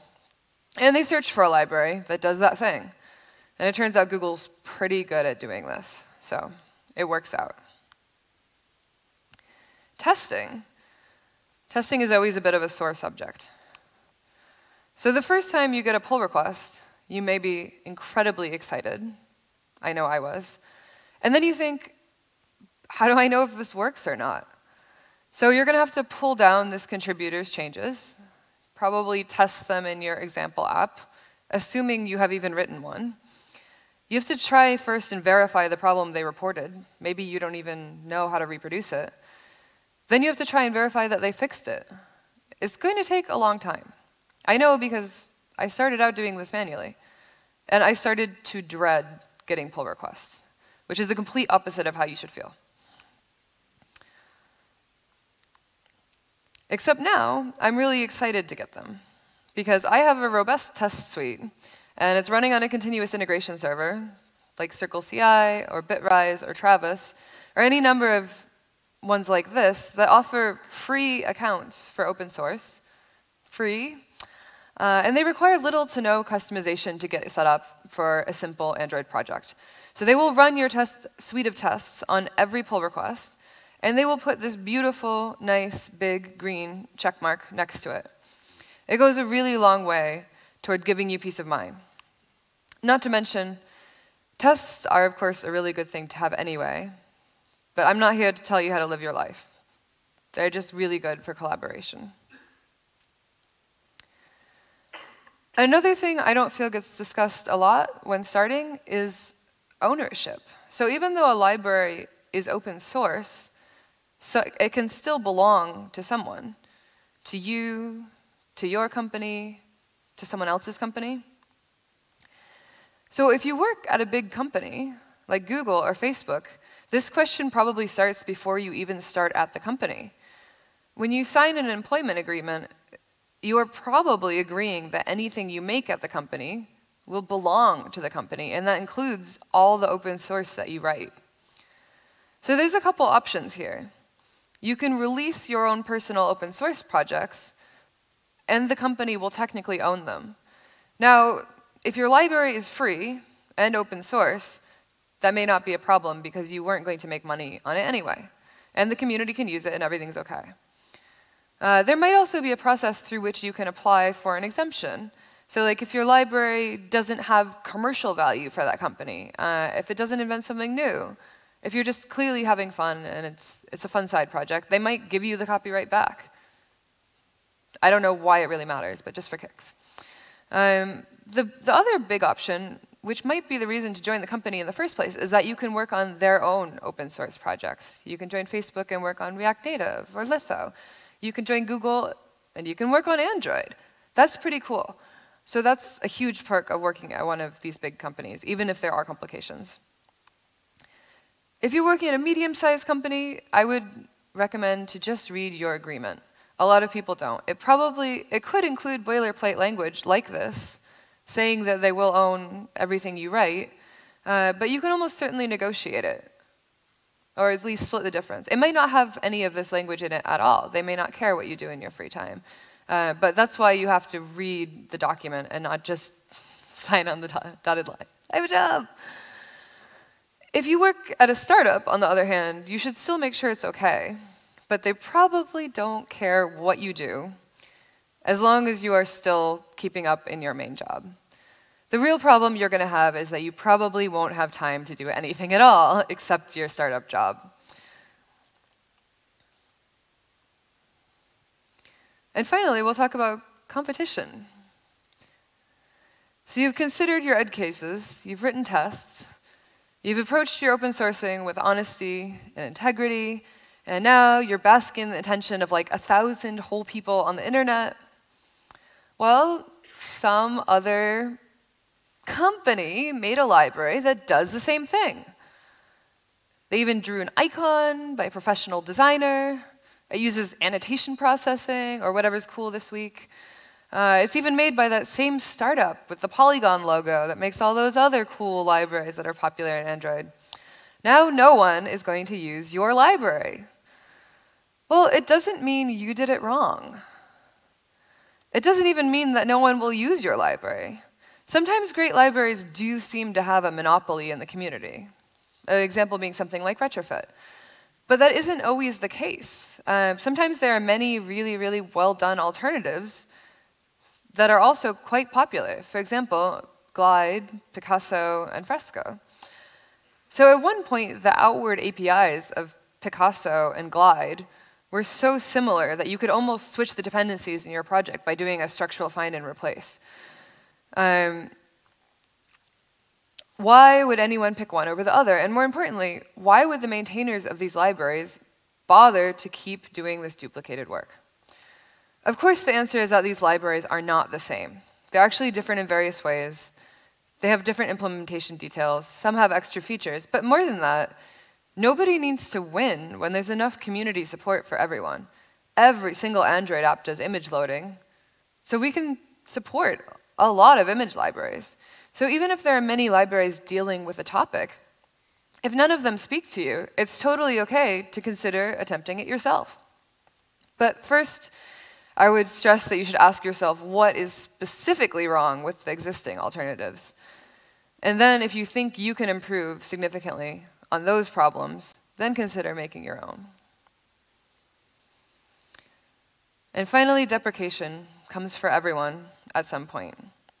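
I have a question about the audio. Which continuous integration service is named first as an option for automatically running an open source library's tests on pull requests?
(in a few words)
CircleCI.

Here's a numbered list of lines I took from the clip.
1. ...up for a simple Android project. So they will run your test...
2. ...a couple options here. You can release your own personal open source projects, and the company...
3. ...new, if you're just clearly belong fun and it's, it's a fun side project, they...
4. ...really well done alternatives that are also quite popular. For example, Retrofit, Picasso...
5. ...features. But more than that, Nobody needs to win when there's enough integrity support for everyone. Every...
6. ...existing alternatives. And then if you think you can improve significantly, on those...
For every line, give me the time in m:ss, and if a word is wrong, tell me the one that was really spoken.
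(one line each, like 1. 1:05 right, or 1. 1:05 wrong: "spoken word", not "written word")
1. 1:17 right
2. 2:22 right
3. 2:50 wrong: "having", not "belong"
4. 5:11 wrong: "Glide", not "Retrofit"
5. 5:49 wrong: "community", not "integrity"
6. 6:15 right.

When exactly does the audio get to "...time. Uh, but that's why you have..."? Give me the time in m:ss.
3:42.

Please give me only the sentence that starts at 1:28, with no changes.
It goes a really long way toward giving you peace of mind.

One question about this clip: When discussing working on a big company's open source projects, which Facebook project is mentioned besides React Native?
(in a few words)
Litho.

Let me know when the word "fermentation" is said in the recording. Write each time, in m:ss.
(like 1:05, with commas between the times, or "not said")
not said.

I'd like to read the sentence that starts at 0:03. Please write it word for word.
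And it turns out Google's pretty good at doing this, so it works out testing.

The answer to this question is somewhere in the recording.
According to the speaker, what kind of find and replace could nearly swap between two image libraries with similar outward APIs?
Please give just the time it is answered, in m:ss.
5:28.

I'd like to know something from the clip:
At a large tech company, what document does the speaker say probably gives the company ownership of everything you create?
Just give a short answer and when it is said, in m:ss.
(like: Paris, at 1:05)
employment agreement, at 2:11.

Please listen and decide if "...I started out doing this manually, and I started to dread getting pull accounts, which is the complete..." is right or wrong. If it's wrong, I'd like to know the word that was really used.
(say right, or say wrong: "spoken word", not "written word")
wrong: "requests", not "accounts".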